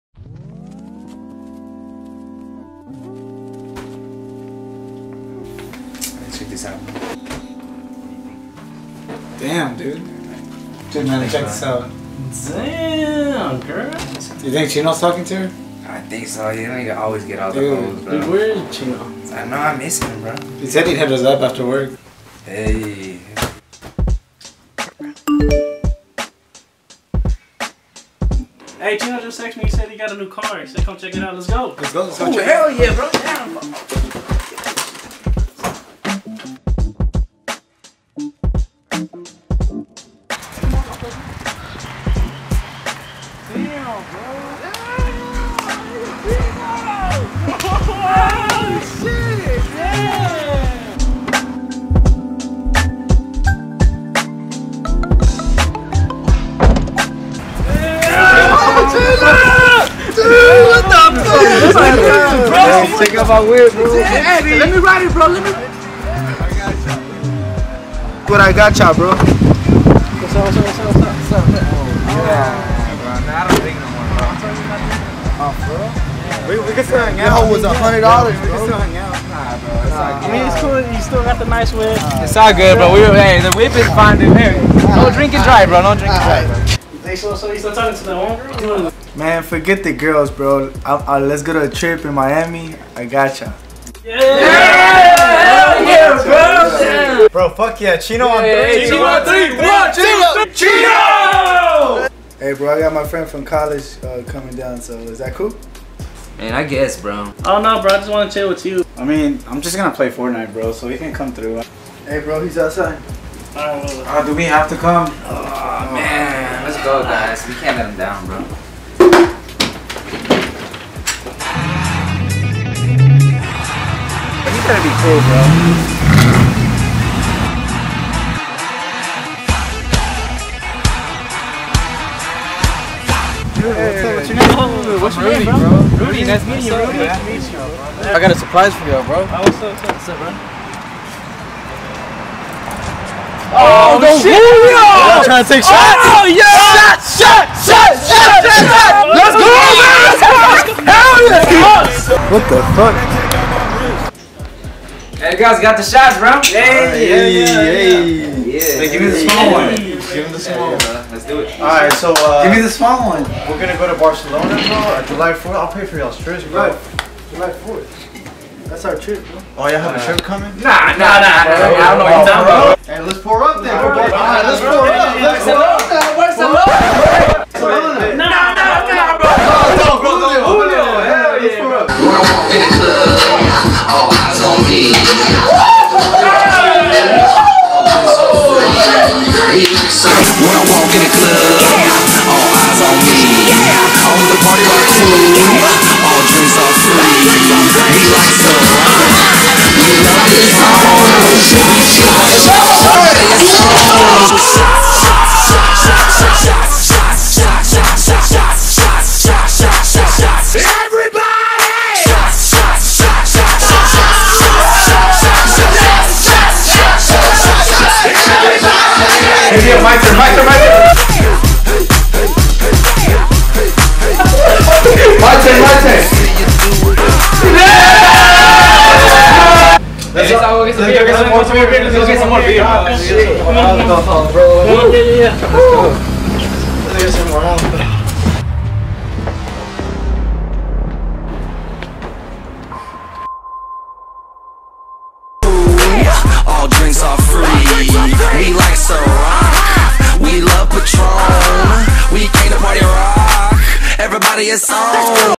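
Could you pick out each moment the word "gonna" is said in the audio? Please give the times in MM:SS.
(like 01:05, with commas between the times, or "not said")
02:04, 02:43.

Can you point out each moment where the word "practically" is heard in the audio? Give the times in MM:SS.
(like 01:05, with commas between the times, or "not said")
not said.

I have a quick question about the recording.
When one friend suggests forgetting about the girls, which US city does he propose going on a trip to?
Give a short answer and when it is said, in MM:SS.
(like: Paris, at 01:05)
Miami, at 01:32.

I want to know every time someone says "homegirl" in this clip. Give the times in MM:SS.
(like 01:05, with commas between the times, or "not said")
01:28.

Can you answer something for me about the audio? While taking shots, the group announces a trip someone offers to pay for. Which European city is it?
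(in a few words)
Barcelona.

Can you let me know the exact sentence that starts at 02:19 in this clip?
Oh, what's up, what's up, bro?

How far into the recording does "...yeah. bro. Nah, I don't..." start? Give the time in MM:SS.
01:12.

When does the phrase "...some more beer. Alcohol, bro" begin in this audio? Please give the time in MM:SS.
03:52.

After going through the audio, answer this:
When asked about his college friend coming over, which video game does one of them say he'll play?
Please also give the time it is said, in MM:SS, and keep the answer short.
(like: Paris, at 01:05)
Fortnite, at 01:50.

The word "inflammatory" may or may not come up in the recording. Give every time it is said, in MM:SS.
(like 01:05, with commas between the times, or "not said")
not said.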